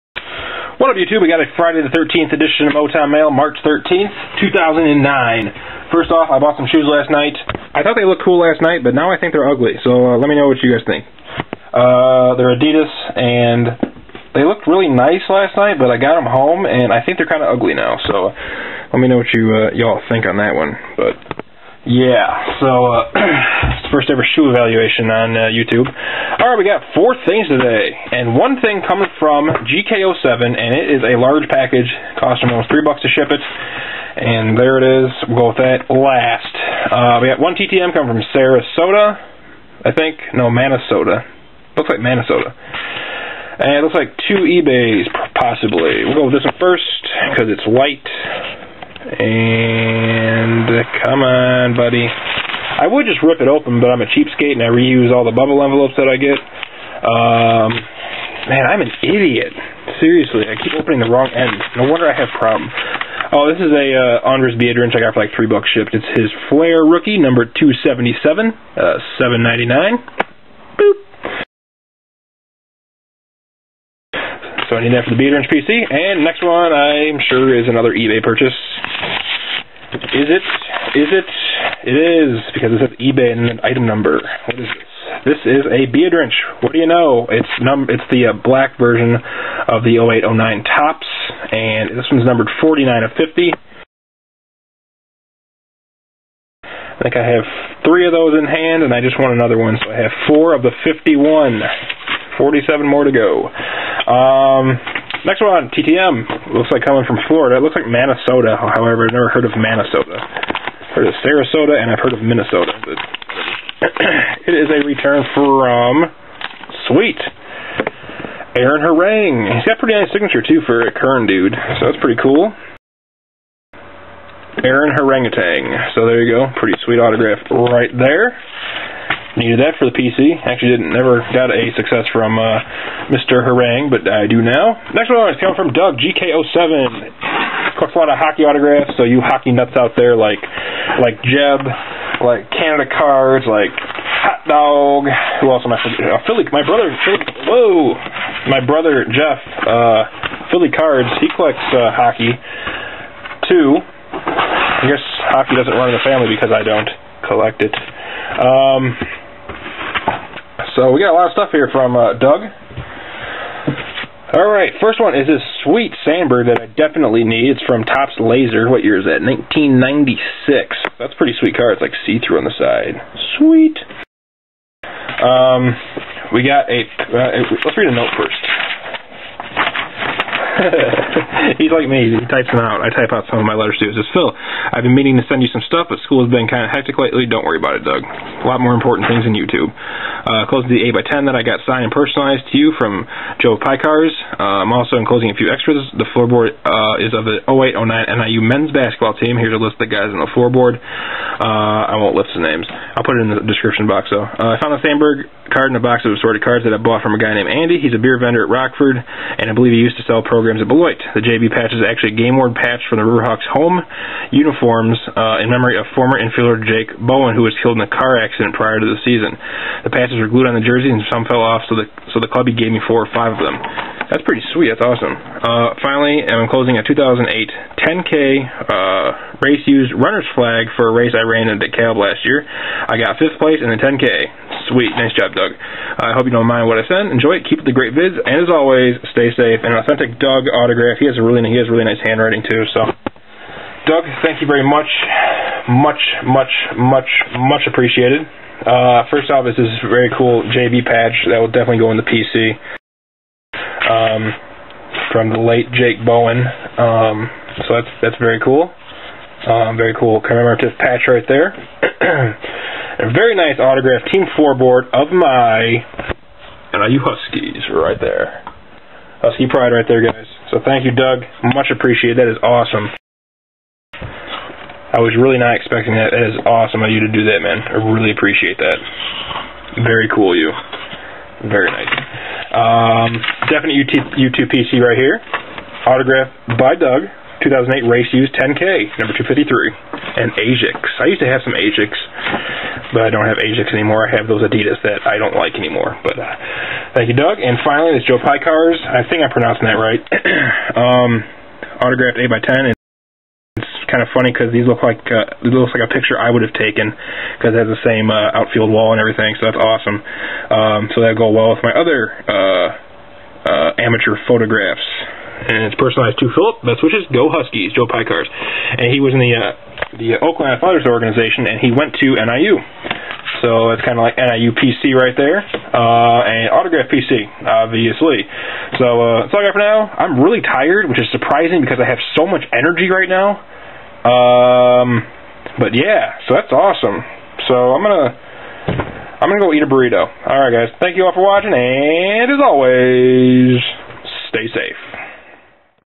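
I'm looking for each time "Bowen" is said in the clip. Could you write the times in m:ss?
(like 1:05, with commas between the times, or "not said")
3:36, 4:16.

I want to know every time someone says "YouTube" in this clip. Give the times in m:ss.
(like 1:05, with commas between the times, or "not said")
0:00, 0:25, 3:09.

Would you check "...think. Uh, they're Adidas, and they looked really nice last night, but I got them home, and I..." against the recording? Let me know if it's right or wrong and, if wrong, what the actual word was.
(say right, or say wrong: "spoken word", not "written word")
right.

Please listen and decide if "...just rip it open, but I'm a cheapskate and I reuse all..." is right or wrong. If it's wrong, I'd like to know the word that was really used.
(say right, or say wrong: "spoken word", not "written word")
right.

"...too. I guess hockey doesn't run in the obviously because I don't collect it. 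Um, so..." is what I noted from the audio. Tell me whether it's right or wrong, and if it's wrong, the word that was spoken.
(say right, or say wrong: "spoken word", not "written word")
wrong: "family", not "obviously".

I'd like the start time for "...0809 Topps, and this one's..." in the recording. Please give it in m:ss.
1:29.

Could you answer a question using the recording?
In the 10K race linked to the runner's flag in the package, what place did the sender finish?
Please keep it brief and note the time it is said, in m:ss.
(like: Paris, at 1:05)
5th, at 3:53.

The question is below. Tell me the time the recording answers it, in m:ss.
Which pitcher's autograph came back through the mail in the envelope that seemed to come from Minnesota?
1:58.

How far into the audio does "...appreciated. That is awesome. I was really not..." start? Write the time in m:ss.
4:31.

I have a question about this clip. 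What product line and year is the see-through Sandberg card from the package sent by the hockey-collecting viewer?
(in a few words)
1996 Topps Laser.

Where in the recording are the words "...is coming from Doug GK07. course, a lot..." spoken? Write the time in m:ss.
2:15.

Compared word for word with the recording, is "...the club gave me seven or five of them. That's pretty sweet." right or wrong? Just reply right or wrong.
wrong.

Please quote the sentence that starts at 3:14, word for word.
Uh, I'm also enclosing a few extras.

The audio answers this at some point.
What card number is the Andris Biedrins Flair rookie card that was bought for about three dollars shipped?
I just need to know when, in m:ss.
1:07.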